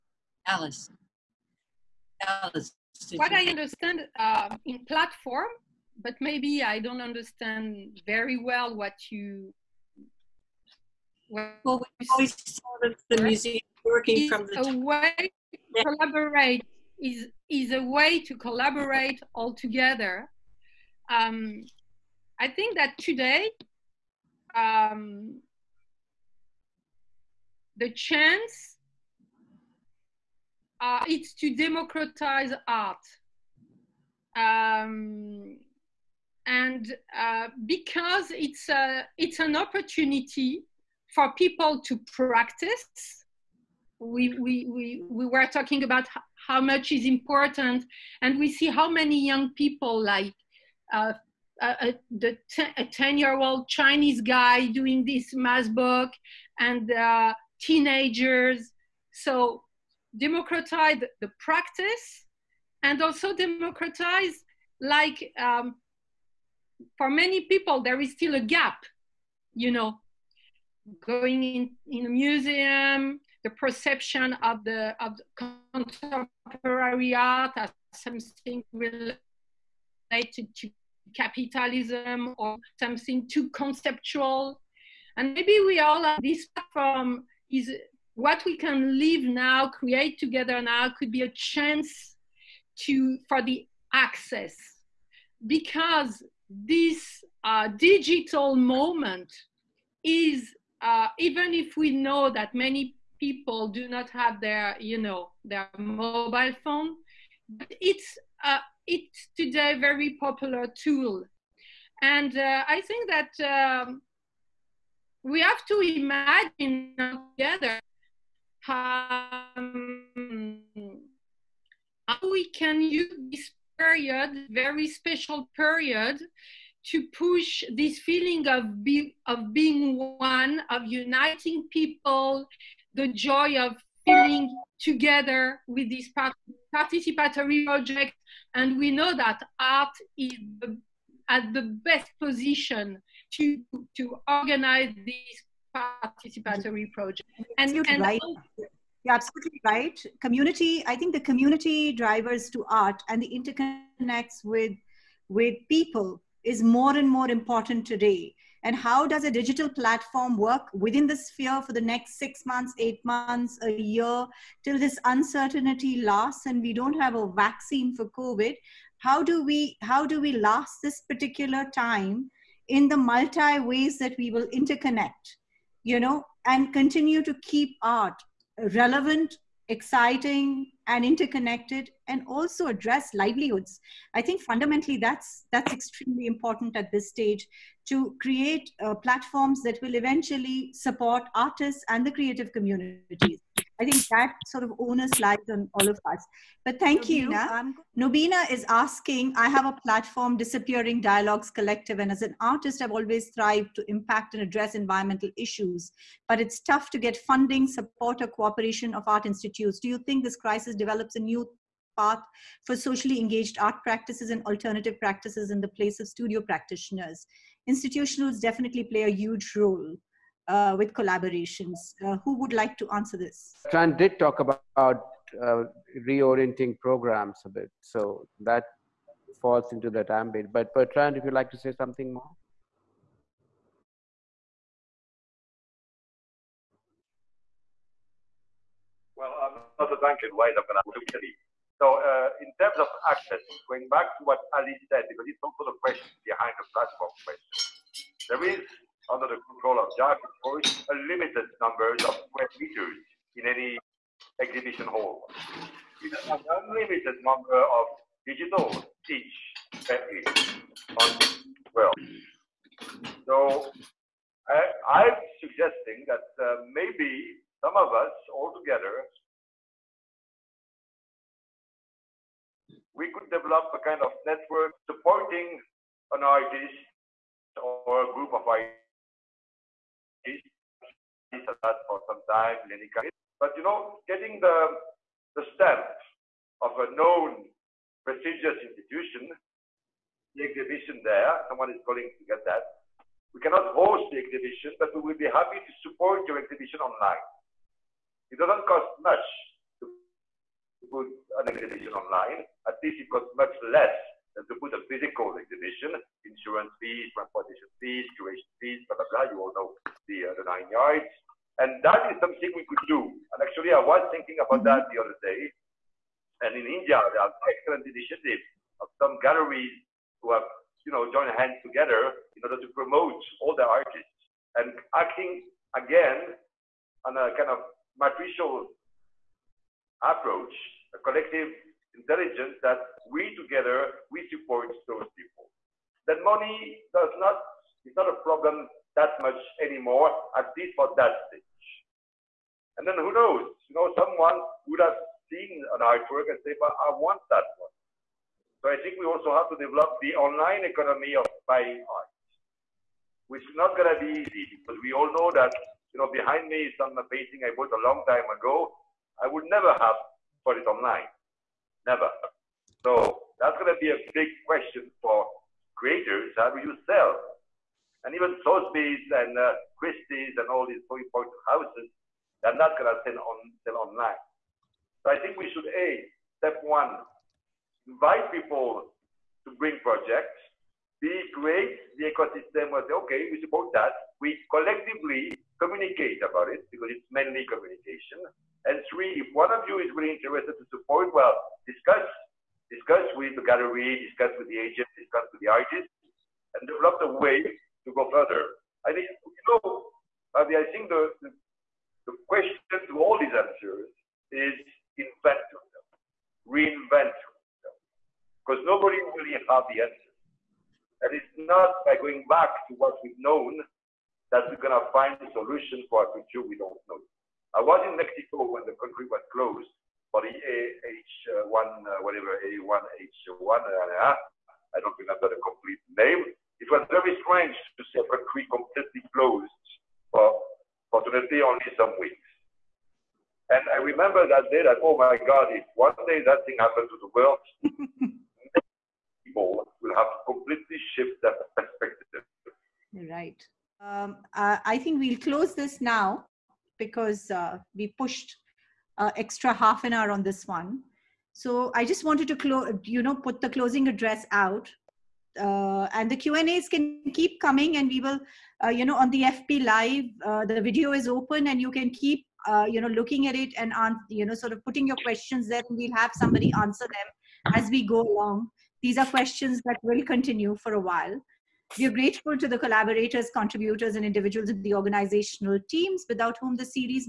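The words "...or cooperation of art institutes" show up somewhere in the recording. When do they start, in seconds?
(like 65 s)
208 s.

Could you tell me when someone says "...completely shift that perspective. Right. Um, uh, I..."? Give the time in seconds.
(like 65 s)
440 s.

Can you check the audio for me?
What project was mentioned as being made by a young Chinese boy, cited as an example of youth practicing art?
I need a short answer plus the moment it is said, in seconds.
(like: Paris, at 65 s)
Maskbook, at 55 s.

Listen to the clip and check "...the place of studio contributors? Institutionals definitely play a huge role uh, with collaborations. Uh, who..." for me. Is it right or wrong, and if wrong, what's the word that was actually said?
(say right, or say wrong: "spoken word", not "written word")
wrong: "practitioners", not "contributors".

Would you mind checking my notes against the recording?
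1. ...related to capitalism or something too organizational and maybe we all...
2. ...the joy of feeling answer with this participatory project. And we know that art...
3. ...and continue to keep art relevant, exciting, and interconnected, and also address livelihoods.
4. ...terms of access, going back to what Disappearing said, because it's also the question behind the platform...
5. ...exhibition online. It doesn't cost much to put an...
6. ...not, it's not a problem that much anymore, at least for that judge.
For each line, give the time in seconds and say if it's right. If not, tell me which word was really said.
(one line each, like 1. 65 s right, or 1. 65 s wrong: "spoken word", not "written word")
1. 78 s wrong: "conceptual", not "organizational"
2. 132 s wrong: "together", not "answer"
3. 176 s right
4. 242 s wrong: "Ali", not "Disappearing"
5. 296 s right
6. 337 s wrong: "stage", not "judge".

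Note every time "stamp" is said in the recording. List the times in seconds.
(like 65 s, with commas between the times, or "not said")
285 s.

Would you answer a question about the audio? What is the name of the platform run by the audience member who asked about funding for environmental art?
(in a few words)
Disappearing Dialogues Collective.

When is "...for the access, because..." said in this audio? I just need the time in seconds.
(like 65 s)
93 s.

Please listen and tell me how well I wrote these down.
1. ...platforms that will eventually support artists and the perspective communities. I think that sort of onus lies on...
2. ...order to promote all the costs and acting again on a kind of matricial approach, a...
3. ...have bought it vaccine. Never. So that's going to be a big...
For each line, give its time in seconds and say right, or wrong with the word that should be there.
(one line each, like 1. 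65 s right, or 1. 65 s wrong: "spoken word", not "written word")
1. 188 s wrong: "creative", not "perspective"
2. 322 s wrong: "artists", not "costs"
3. 359 s wrong: "online", not "vaccine".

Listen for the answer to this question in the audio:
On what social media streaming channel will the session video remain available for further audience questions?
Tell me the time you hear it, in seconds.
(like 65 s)
459 s.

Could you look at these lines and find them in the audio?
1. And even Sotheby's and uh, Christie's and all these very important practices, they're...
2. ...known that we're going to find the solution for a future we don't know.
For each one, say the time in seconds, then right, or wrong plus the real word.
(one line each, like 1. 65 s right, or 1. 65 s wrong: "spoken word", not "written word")
1. 368 s wrong: "houses", not "practices"
2. 413 s right.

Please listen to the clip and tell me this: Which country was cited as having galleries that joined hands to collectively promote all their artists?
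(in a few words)
India.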